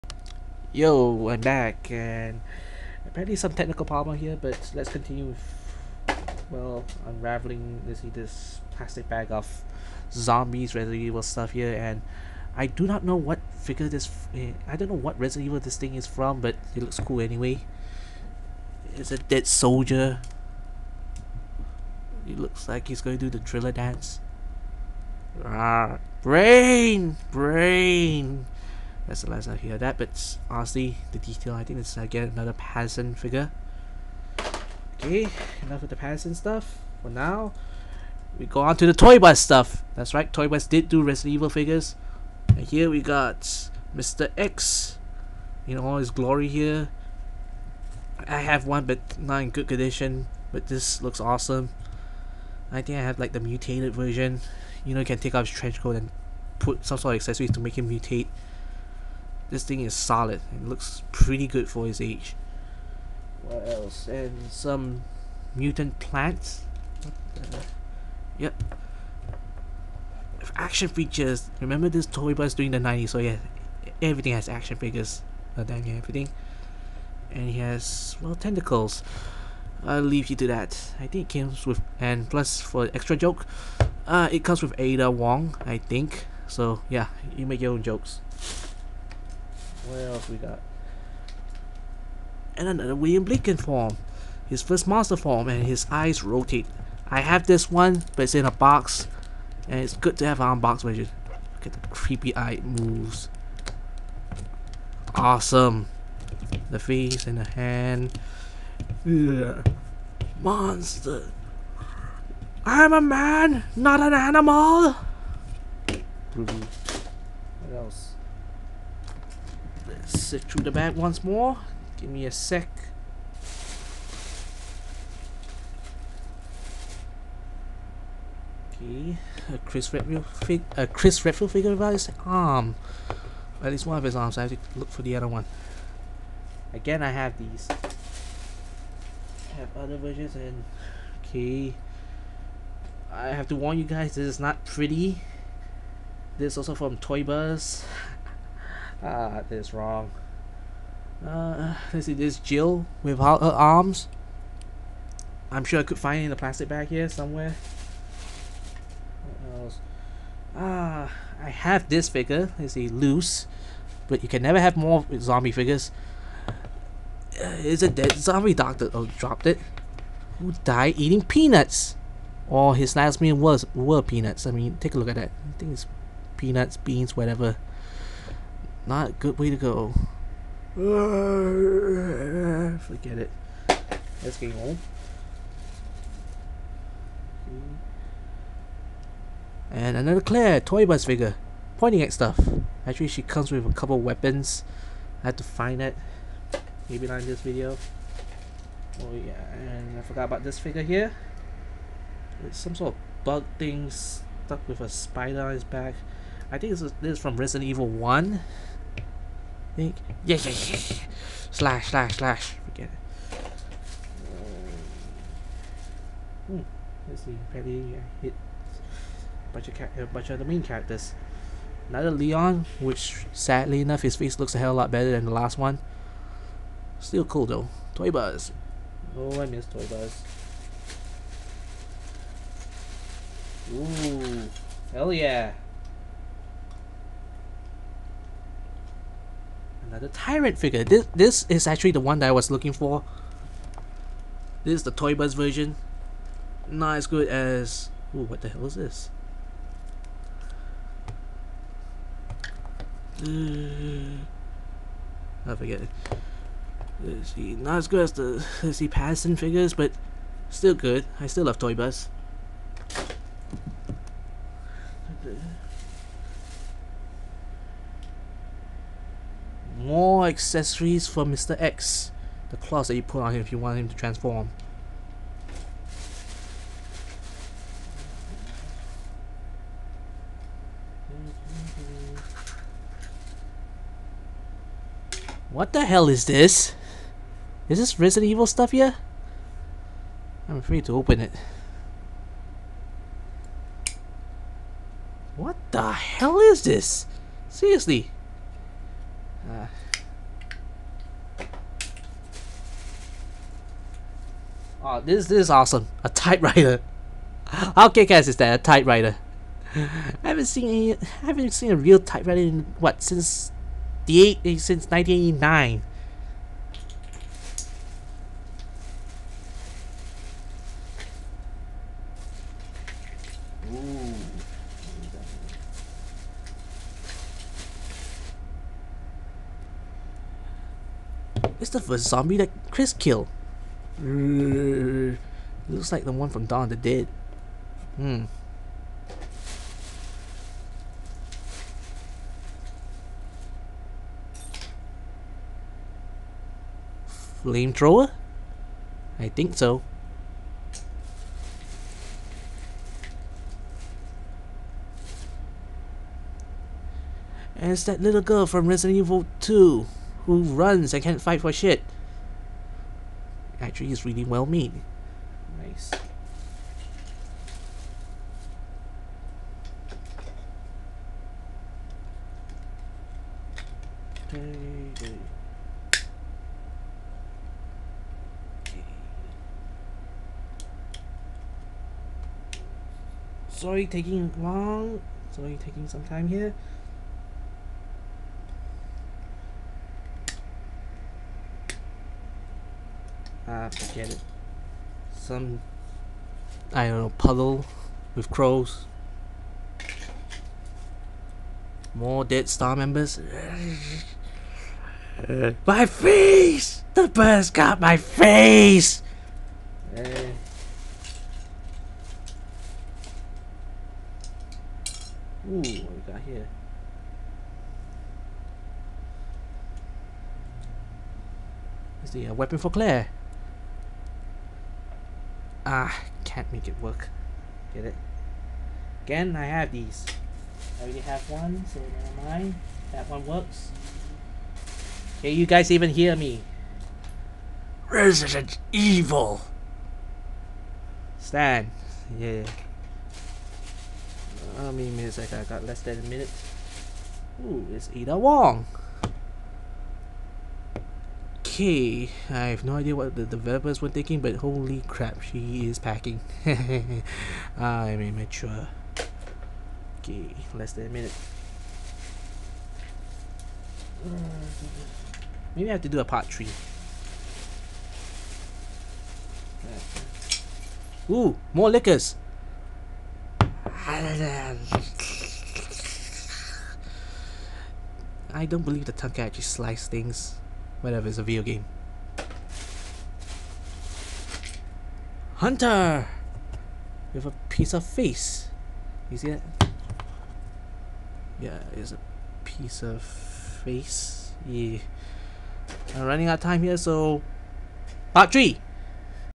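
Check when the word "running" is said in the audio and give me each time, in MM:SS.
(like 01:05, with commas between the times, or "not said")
08:16.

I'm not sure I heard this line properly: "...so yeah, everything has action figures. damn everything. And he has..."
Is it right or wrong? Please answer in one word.
right.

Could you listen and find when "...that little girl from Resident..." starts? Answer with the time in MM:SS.
05:57.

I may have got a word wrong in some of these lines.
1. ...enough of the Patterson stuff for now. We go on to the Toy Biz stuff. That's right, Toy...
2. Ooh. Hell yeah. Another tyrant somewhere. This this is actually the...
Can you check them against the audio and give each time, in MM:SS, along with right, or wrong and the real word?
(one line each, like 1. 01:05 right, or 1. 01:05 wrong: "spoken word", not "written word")
1. 00:35 right
2. 03:53 wrong: "figure", not "somewhere".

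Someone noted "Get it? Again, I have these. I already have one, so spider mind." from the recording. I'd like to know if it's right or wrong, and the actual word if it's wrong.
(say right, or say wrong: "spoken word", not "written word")
wrong: "never", not "spider".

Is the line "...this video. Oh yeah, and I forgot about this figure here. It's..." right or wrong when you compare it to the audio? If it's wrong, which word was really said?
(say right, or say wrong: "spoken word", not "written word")
right.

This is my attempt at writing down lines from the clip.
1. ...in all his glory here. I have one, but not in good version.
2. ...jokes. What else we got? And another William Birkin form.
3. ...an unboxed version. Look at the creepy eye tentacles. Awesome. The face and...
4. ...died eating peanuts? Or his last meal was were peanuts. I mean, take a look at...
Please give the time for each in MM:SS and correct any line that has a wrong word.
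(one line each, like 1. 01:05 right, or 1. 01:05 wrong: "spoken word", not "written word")
1. 00:45 wrong: "condition", not "version"
2. 01:27 right
3. 01:40 wrong: "moves", not "tentacles"
4. 02:50 right.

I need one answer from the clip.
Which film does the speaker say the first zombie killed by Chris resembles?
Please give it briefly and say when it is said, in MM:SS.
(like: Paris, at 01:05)
Dawn of the Dead, at 05:36.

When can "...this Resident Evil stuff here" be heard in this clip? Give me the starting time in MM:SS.
04:47.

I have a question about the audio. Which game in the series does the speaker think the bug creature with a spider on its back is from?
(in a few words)
Resident Evil 1.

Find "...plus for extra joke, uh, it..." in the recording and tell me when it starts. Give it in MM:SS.
01:22.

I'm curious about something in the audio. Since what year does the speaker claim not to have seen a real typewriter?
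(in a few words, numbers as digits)
1989.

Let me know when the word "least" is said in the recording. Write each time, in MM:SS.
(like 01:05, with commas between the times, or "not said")
02:13.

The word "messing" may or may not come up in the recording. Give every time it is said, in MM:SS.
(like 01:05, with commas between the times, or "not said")
not said.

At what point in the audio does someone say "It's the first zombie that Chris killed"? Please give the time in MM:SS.
05:31.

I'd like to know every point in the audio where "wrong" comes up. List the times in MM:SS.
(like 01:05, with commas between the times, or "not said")
02:29.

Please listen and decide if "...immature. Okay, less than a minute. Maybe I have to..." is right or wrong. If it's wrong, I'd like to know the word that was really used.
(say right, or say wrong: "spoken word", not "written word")
right.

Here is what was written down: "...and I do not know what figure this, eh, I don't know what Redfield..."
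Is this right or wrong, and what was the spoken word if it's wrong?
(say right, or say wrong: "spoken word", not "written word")
wrong: "Resident", not "Redfield".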